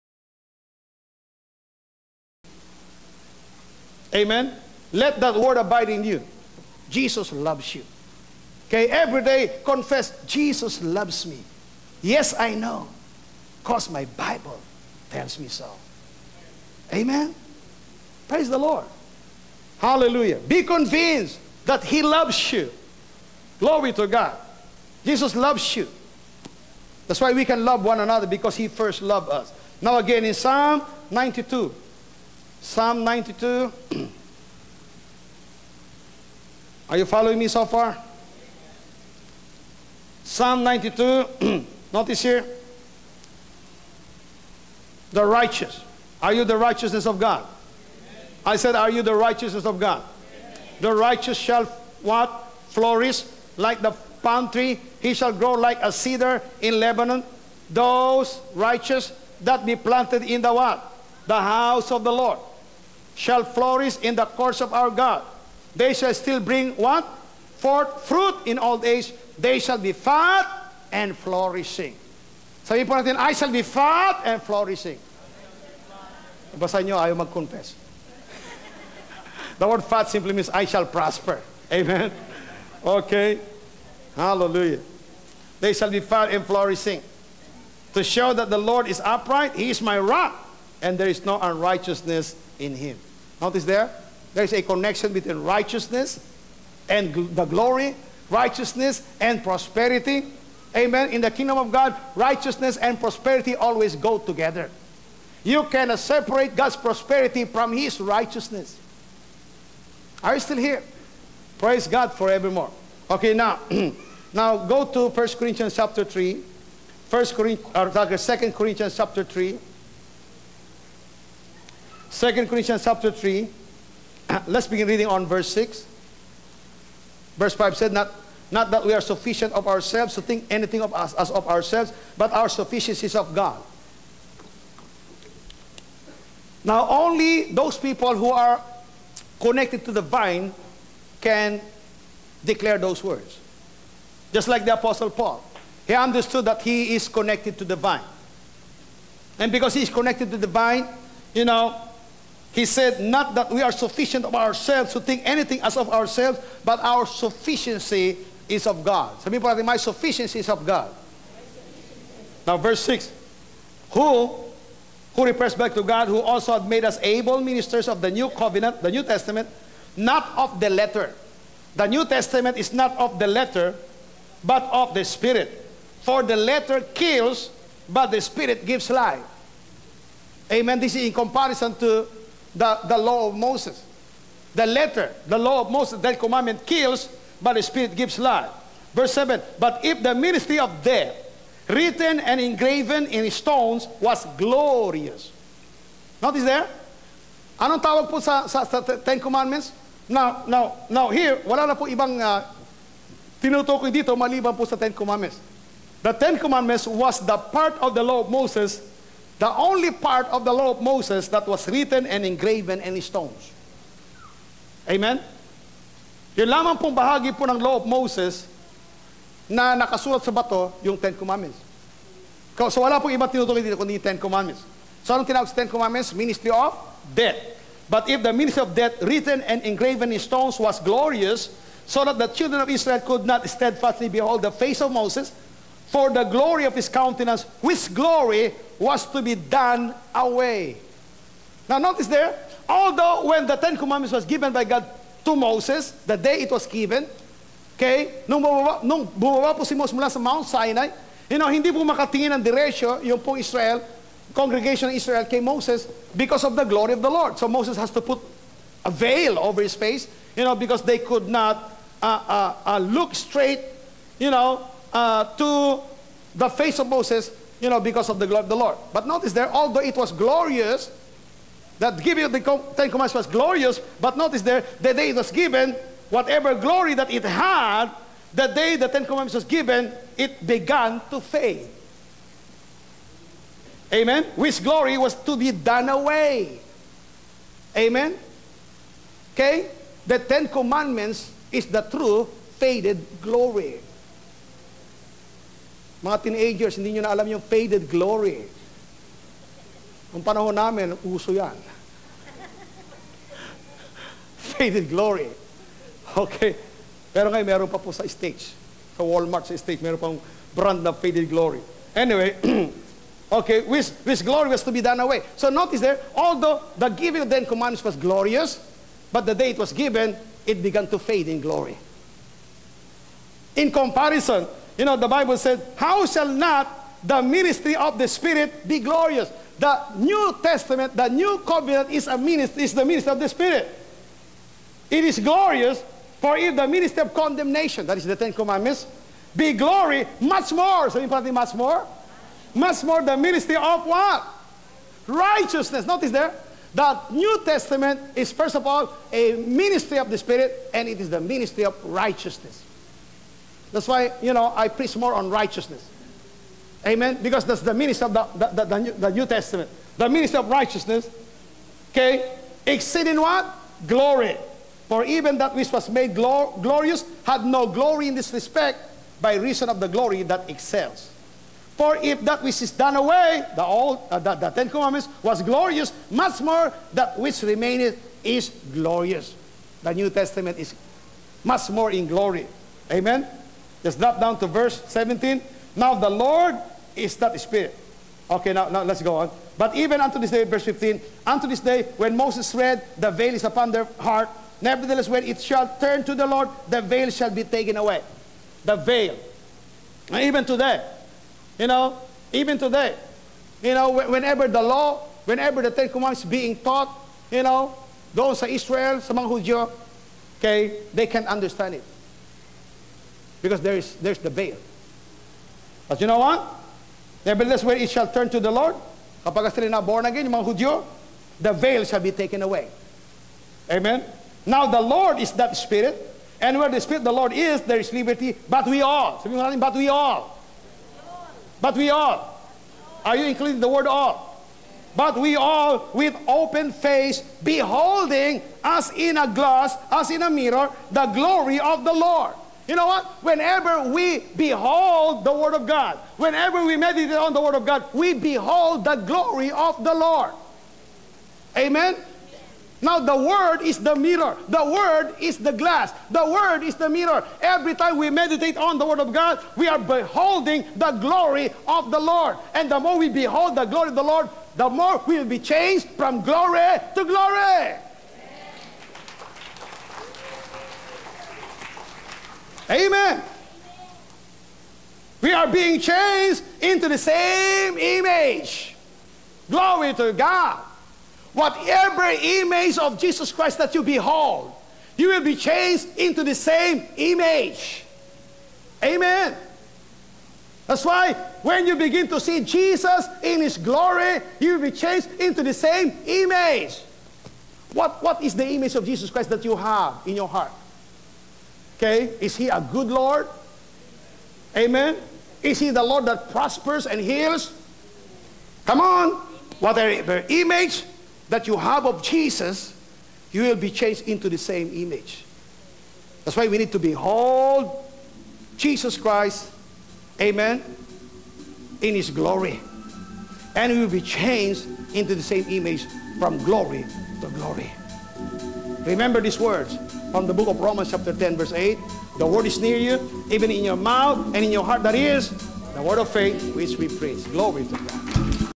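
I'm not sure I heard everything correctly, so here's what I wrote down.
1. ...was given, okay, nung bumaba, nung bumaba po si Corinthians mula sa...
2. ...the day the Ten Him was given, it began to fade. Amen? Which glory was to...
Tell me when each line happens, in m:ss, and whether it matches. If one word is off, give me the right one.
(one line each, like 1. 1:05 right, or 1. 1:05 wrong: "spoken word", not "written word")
1. 4:06 wrong: "Moses", not "Corinthians"
2. 4:38 wrong: "Commandments", not "Him".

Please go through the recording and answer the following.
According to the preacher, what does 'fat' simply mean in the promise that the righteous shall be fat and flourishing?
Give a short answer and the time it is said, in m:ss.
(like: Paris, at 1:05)
I shall prosper, at 1:20.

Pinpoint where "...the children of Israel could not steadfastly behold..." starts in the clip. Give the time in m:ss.
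3:52.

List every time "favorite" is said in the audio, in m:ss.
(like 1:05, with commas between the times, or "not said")
not said.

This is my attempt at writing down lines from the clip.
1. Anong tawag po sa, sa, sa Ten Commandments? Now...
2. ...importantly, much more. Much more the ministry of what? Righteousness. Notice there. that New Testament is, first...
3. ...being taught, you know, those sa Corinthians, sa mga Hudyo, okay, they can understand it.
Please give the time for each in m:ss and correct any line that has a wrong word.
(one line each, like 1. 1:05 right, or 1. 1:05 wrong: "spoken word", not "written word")
1. 3:17 right
2. 5:40 right
3. 6:46 wrong: "Israel", not "Corinthians".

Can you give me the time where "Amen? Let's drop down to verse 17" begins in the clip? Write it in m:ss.
6:22.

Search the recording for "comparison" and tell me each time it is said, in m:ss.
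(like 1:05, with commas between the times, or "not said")
3:01, 5:23.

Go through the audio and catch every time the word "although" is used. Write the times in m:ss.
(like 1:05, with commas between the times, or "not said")
4:02, 4:29, 5:16.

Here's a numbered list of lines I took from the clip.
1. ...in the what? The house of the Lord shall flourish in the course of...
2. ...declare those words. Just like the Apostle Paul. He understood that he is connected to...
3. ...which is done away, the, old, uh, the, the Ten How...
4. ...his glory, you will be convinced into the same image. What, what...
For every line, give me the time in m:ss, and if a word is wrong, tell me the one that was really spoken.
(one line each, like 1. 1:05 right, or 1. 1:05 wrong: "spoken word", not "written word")
1. 1:00 right
2. 2:22 right
3. 6:12 wrong: "Commandments", not "How"
4. 8:13 wrong: "changed", not "convinced".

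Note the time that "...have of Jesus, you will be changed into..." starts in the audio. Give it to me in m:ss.
8:31.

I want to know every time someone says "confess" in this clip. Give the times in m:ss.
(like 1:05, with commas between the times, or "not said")
0:09, 1:17.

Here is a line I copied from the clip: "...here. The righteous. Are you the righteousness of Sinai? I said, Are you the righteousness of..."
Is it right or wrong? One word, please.
wrong.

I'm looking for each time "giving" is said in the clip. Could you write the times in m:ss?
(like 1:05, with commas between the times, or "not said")
4:32, 5:16.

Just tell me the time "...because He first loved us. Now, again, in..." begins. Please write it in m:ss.
0:28.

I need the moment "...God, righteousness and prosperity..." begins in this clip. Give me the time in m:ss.
1:41.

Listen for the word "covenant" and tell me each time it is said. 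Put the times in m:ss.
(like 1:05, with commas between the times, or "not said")
2:48, 5:31.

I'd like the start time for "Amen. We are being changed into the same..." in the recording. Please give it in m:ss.
7:52.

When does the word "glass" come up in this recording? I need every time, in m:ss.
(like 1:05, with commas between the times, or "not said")
7:19, 7:35.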